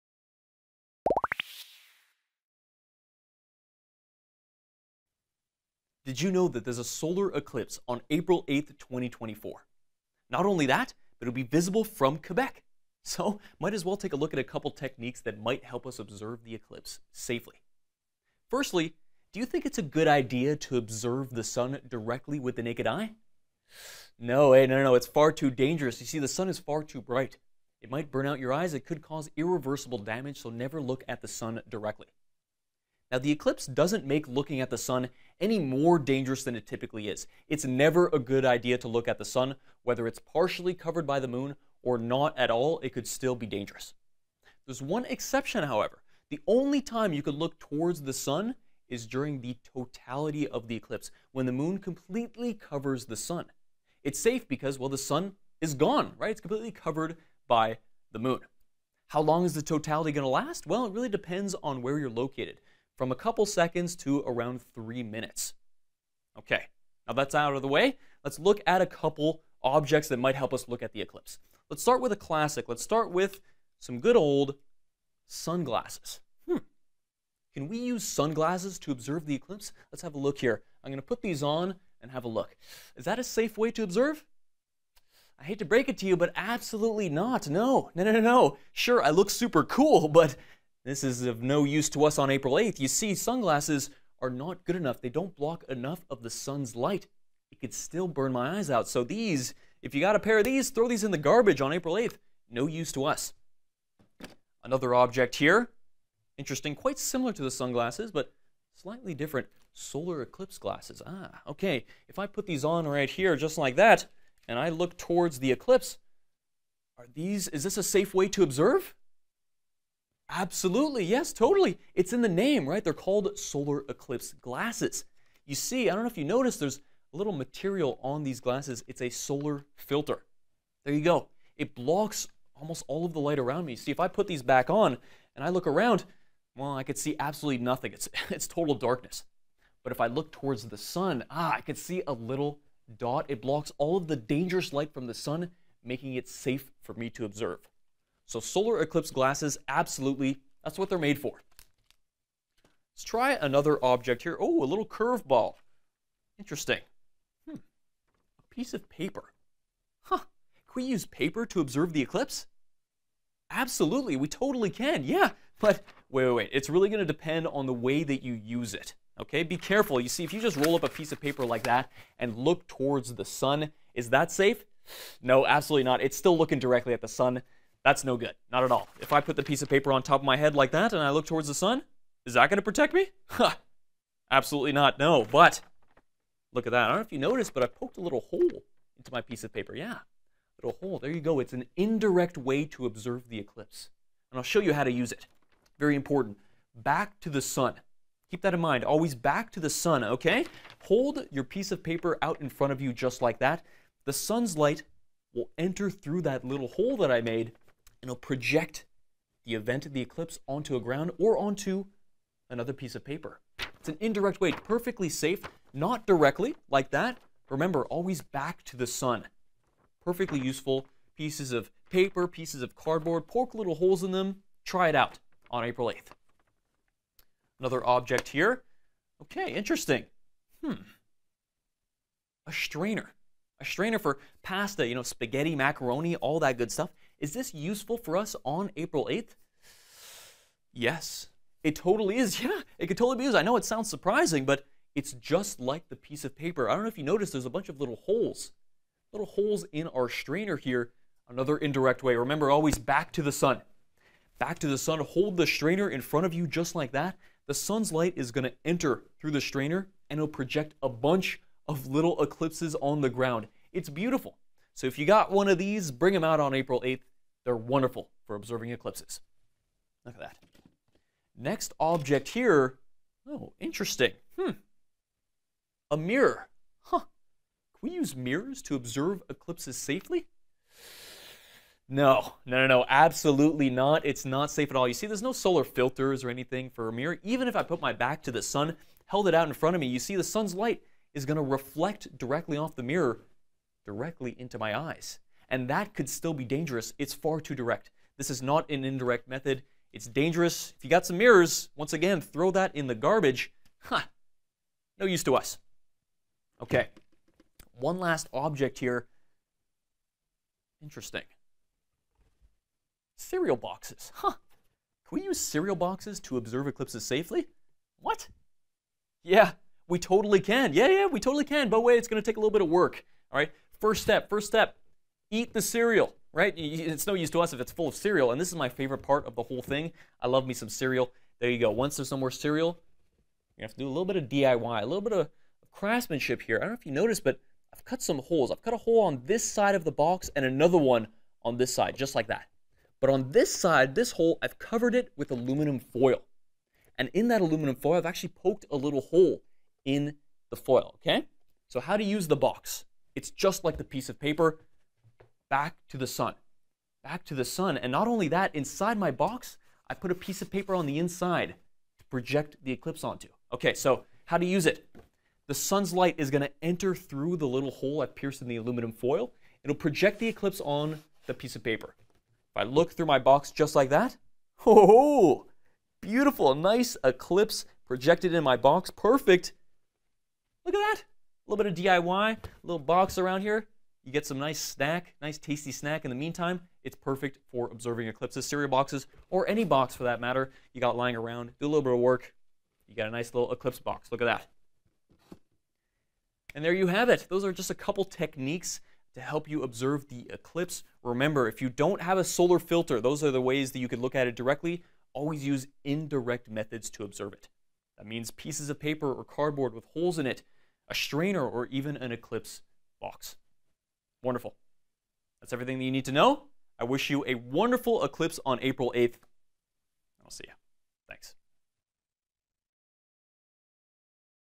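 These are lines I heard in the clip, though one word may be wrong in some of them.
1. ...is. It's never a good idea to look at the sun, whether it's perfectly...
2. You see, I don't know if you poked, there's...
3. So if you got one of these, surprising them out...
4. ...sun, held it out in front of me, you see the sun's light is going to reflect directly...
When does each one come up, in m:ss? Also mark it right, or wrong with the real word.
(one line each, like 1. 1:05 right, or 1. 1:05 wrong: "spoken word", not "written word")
1. 0:37 wrong: "partially", not "perfectly"
2. 2:05 wrong: "noticed", not "poked"
3. 4:24 wrong: "bring", not "surprising"
4. 4:48 right.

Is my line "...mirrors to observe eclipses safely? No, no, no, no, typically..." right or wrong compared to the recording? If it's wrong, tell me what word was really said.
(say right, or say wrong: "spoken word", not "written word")
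wrong: "absolutely", not "typically".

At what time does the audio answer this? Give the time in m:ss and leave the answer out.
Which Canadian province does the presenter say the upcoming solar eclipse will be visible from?
0:12.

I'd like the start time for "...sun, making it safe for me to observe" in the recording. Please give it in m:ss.
2:25.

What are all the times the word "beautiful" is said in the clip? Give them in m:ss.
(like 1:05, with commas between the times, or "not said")
4:23, 6:16.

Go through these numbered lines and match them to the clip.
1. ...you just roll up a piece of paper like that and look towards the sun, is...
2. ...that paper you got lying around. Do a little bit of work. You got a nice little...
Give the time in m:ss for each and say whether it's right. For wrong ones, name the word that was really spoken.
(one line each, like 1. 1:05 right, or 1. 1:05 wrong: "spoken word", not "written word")
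1. 2:50 right
2. 6:30 wrong: "matter", not "paper".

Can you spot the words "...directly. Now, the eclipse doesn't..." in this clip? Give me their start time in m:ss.
0:31.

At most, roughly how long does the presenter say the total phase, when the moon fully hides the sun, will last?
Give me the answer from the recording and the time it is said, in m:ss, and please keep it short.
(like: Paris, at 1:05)
around 3 minutes, at 1:04.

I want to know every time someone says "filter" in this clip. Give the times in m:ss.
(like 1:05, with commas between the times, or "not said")
2:09, 4:45, 6:42.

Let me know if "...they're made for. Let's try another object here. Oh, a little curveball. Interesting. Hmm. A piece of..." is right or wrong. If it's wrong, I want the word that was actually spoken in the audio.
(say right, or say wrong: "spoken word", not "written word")
right.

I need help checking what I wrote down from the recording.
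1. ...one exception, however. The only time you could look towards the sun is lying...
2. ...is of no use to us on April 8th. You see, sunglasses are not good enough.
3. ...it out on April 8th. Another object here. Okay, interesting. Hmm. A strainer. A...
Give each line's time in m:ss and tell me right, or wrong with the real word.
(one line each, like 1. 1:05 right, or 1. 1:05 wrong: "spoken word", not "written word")
1. 0:44 wrong: "during", not "lying"
2. 1:31 right
3. 3:44 right.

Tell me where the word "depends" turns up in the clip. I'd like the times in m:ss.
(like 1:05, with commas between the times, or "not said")
1:01, 2:47.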